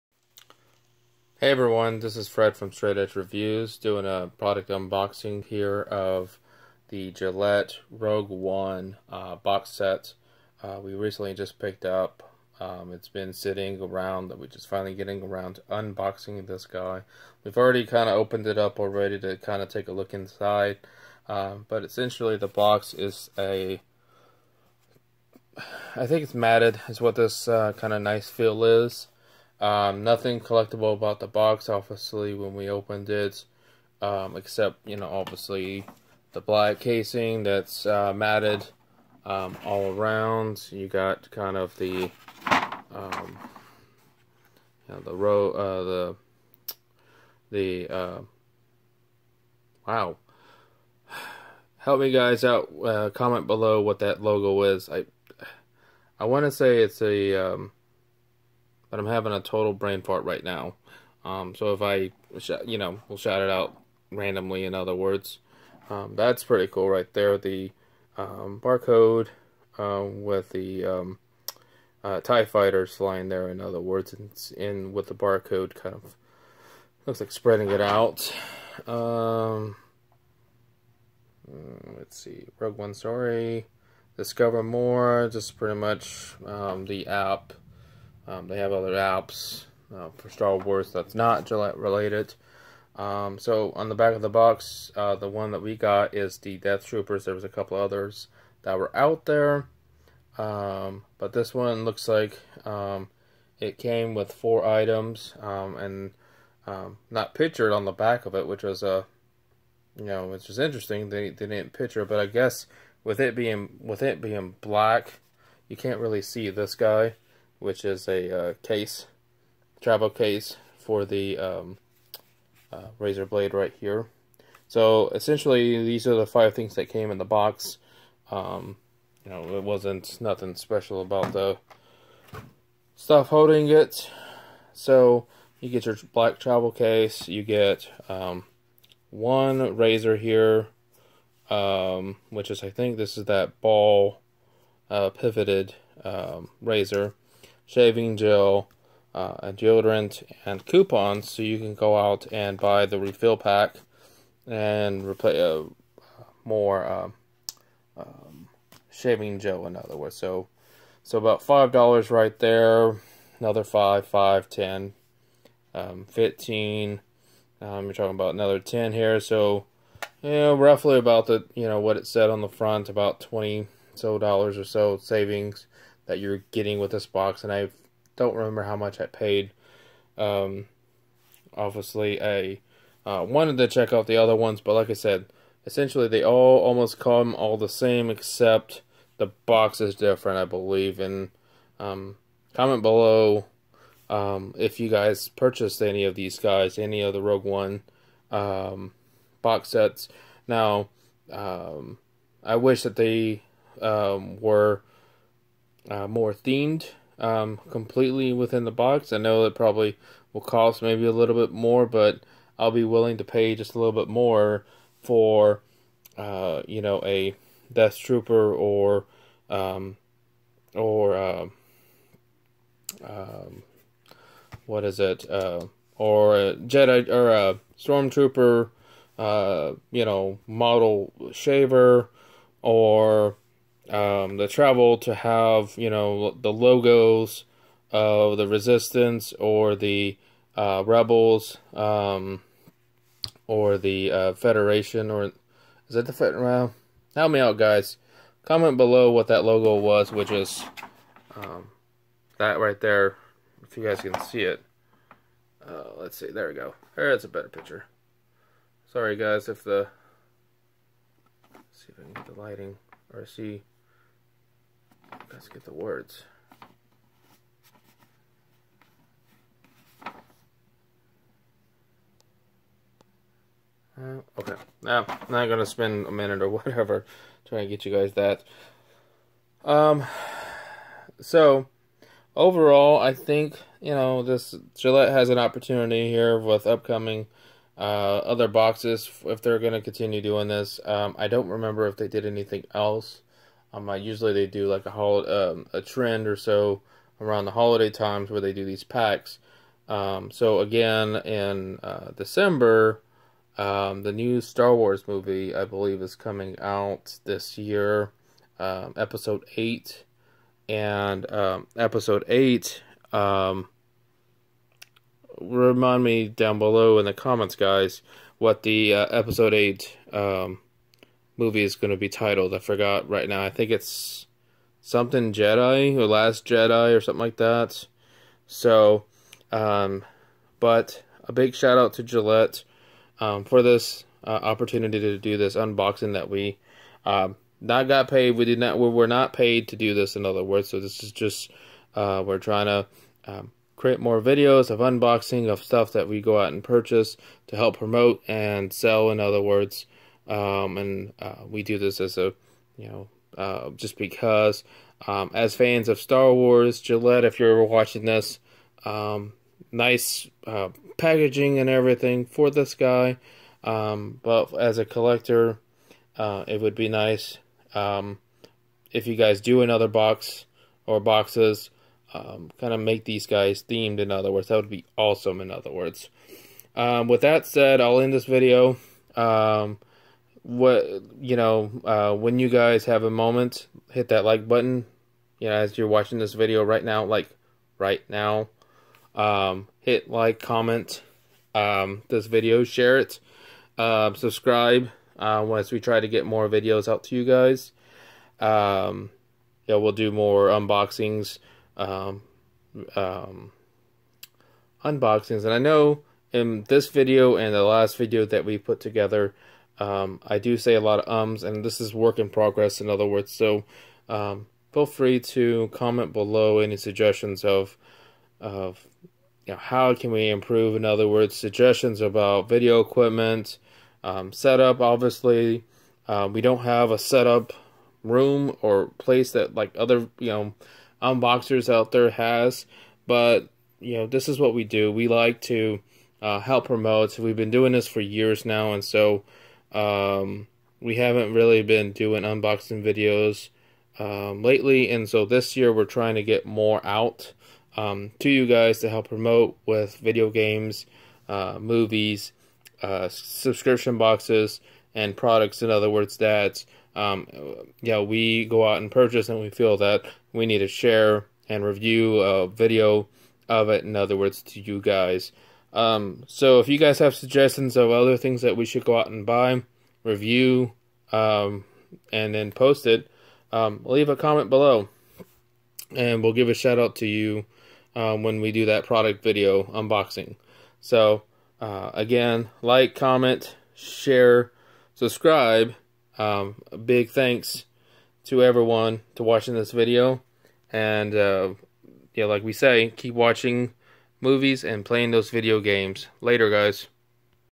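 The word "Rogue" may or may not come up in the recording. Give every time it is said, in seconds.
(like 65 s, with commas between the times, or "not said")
7 s, 82 s, 197 s.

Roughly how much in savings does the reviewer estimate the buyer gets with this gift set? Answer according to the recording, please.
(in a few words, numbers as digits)
$20.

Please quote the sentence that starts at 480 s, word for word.
So uh, again, like, comment, share, subscribe.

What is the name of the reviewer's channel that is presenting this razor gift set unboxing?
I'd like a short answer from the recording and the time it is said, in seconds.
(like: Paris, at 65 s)
Straight Edge Reviews, at 2 s.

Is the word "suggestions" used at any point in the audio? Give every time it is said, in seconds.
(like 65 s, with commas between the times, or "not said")
416 s, 421 s, 467 s.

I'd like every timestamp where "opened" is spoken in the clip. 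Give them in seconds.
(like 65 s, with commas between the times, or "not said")
18 s, 32 s.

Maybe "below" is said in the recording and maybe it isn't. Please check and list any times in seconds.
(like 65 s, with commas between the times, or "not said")
53 s, 192 s, 248 s, 316 s, 416 s, 474 s.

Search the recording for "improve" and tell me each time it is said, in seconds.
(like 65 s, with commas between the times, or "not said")
420 s.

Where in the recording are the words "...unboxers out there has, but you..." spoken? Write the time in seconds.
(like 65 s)
431 s.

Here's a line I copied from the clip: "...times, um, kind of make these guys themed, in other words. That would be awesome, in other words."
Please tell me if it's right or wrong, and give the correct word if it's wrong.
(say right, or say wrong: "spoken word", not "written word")
wrong: "boxes", not "times".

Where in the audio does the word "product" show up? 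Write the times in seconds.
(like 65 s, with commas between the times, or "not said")
4 s, 455 s, 478 s.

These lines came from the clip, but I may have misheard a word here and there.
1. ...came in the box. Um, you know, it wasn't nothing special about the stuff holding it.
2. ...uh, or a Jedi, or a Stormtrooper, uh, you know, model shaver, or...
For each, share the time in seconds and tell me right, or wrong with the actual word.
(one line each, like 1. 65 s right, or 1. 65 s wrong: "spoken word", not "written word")
1. 126 s right
2. 225 s right.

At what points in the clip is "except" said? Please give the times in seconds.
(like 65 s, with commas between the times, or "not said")
34 s, 188 s.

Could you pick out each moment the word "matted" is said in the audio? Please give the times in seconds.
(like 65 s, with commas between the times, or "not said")
26 s, 38 s.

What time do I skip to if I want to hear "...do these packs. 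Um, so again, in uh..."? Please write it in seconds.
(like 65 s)
298 s.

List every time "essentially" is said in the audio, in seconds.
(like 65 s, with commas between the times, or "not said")
21 s, 125 s, 185 s.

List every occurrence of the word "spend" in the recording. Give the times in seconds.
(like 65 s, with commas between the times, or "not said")
275 s.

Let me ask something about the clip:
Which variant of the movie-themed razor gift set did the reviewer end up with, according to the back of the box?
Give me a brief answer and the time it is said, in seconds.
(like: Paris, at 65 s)
Death Troopers, at 96 s.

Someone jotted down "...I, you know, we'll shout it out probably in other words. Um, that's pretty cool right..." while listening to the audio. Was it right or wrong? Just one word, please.
wrong.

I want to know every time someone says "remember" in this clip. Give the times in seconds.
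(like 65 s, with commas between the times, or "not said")
178 s, 291 s.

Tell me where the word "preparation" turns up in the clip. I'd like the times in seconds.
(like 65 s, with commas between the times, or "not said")
not said.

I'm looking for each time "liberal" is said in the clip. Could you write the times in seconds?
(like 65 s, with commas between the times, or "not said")
not said.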